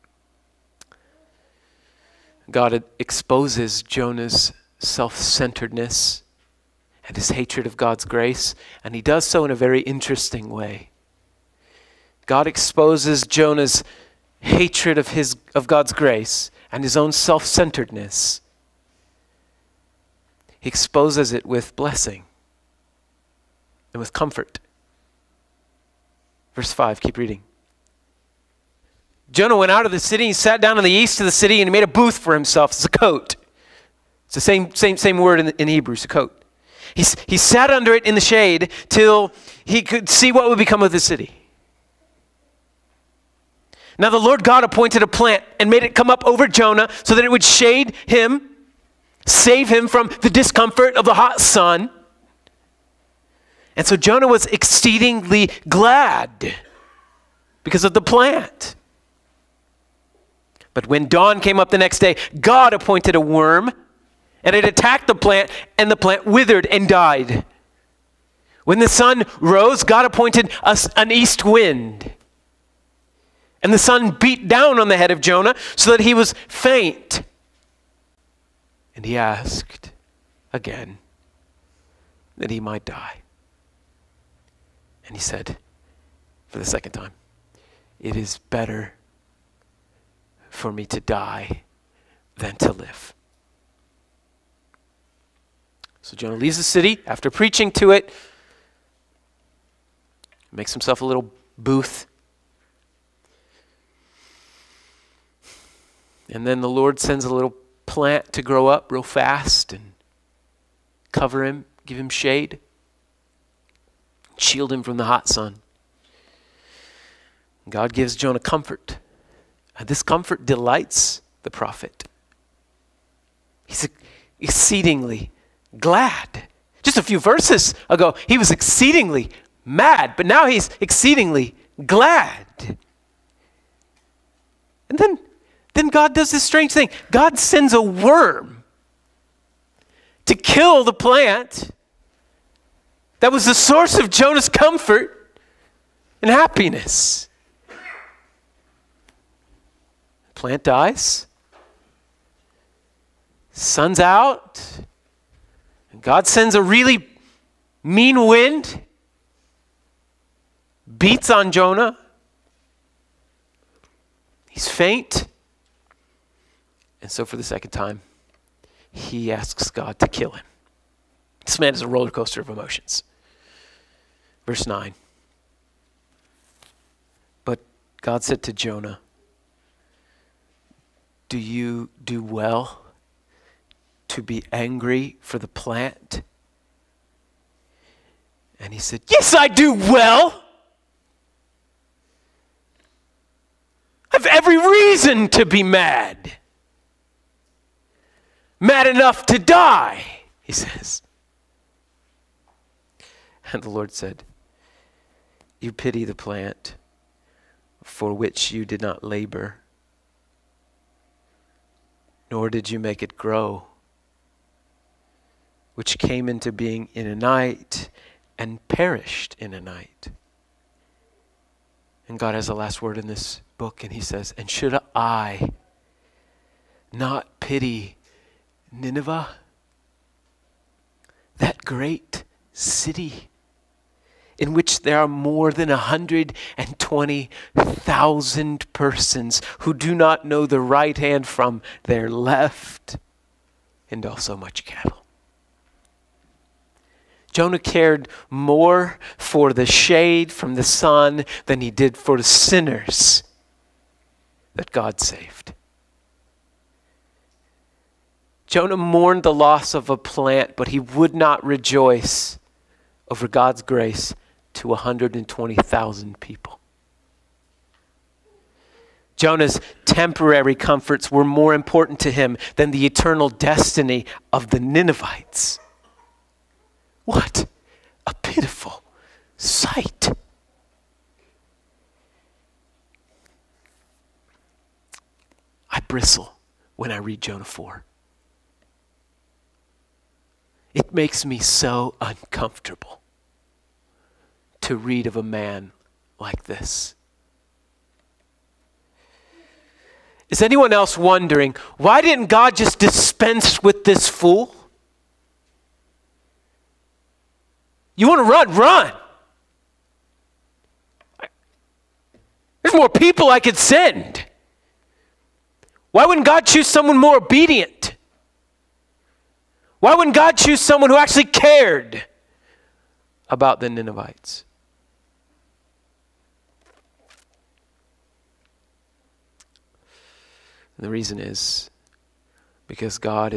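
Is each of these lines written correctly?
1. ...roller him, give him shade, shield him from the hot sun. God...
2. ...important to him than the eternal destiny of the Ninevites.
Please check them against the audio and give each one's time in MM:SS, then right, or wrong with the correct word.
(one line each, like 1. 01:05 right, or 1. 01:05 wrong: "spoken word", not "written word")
1. 01:51 wrong: "cover", not "roller"
2. 04:31 right.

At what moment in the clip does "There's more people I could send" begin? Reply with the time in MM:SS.
05:12.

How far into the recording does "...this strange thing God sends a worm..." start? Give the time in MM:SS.
02:16.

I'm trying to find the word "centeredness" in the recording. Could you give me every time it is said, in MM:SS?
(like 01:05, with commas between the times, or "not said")
00:05, 00:17.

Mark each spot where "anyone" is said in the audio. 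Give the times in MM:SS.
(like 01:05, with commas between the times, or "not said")
05:00.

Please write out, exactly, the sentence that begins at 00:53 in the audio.
And so Jonah was exceedingly glad because of the plant.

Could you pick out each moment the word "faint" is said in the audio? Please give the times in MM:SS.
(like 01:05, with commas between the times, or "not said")
01:16, 02:44.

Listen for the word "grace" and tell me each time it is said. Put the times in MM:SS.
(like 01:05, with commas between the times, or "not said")
00:08, 00:15, 04:23.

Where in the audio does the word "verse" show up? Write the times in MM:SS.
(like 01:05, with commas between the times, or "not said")
00:26, 02:07, 02:54.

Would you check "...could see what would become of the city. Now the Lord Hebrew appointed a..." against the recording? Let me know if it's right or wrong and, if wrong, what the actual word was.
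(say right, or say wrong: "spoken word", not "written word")
wrong: "God", not "Hebrew".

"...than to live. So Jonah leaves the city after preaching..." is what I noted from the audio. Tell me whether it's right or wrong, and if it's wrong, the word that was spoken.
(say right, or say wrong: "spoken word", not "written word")
right.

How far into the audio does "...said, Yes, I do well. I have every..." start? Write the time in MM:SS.
03:08.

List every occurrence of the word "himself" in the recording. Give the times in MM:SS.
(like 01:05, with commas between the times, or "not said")
00:32, 01:40.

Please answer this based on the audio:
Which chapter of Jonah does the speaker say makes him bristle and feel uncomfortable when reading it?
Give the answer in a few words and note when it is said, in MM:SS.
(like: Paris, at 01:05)
Jonah 4, at 04:47.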